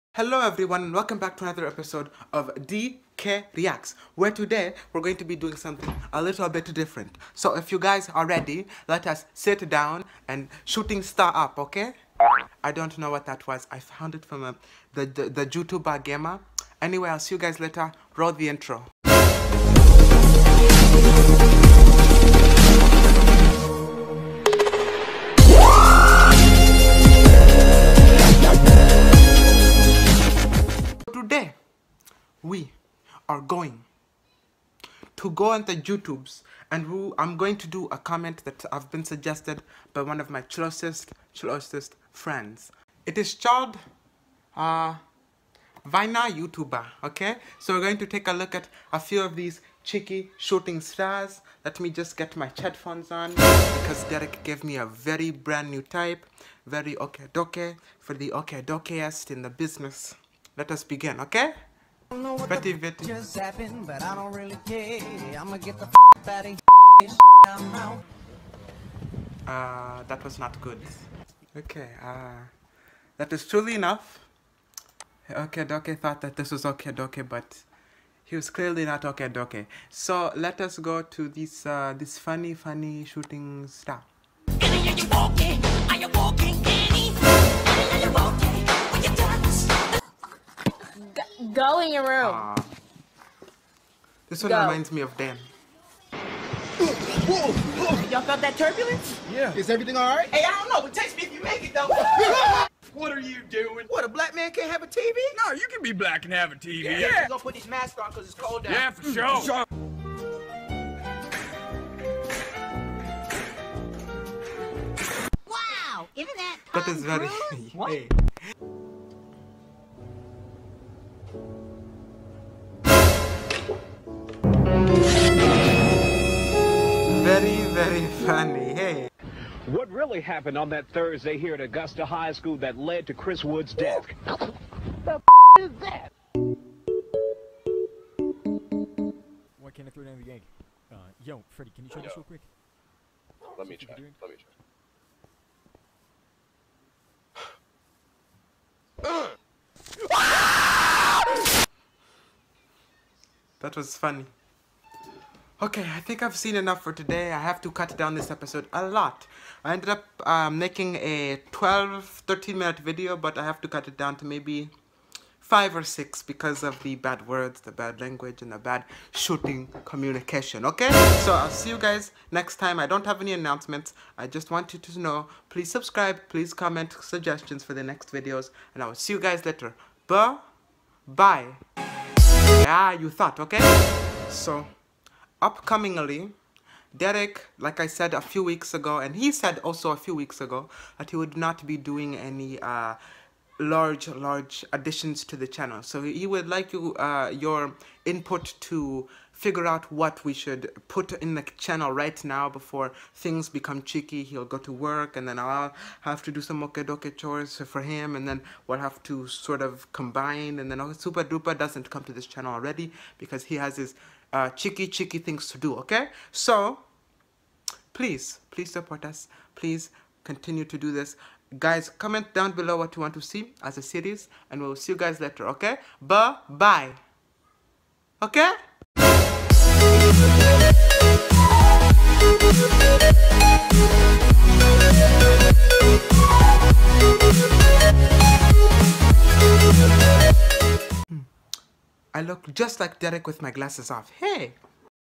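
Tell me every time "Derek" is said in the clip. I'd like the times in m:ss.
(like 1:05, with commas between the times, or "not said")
0:54, 3:06, 4:02.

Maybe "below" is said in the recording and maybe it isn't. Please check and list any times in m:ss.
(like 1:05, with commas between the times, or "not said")
3:42.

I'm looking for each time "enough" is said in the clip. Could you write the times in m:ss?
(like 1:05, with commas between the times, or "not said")
1:13, 2:36.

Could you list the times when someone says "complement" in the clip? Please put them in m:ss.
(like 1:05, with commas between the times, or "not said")
not said.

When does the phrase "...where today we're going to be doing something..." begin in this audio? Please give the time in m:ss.
0:04.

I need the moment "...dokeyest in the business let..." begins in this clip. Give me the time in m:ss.
0:58.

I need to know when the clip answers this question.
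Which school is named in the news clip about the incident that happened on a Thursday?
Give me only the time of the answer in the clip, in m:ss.
2:11.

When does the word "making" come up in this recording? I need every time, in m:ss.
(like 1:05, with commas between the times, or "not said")
2:40.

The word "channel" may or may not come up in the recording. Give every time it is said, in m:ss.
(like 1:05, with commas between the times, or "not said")
3:15, 3:21, 3:32.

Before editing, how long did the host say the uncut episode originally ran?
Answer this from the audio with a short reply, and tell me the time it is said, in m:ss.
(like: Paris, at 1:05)
12, 13 minutes, at 2:41.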